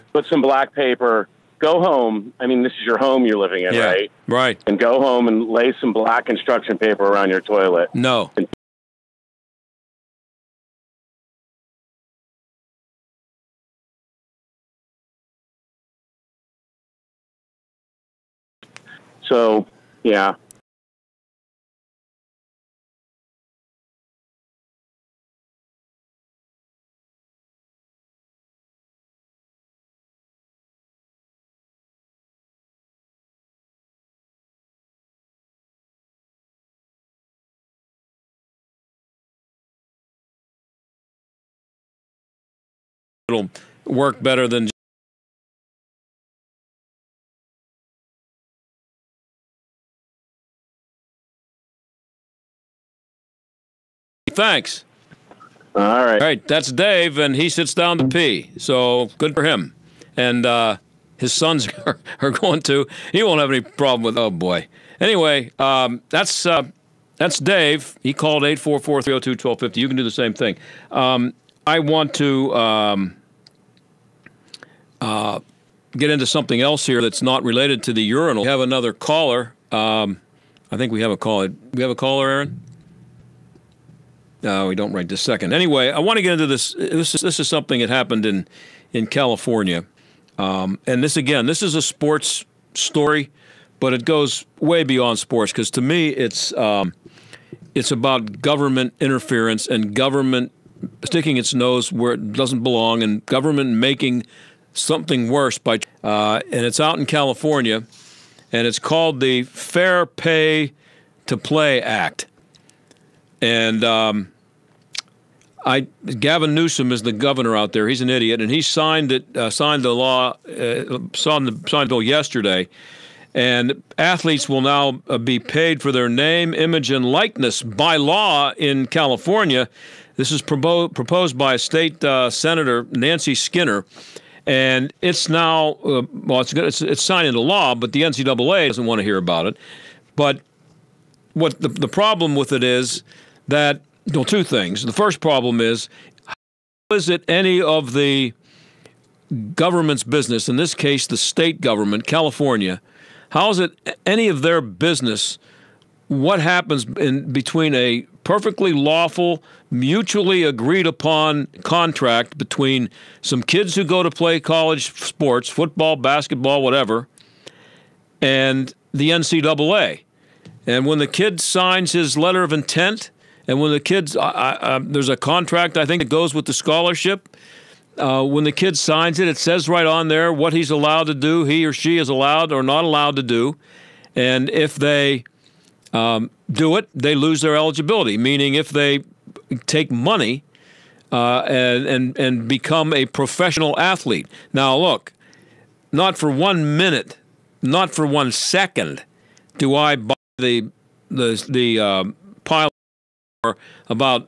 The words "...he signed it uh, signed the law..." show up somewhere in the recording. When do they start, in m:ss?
1:58.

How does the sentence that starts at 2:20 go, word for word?
But what the the problem with it is that well, two things.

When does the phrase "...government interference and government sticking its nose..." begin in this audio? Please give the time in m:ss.
1:38.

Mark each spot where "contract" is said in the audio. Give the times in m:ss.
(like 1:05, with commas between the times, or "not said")
2:41, 2:55.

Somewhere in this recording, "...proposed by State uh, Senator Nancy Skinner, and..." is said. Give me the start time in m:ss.
2:10.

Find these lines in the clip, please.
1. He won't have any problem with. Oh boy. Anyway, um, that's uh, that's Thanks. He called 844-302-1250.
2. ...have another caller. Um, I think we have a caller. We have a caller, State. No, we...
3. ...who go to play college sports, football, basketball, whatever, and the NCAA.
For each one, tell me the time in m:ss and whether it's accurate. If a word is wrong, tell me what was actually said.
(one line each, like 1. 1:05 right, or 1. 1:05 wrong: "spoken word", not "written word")
1. 1:03 wrong: "Dave", not "Thanks"
2. 1:18 wrong: "Aaron", not "State"
3. 2:43 right.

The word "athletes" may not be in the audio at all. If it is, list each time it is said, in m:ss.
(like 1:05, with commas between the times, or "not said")
2:03, 3:13.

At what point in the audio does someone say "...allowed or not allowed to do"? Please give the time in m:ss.
3:02.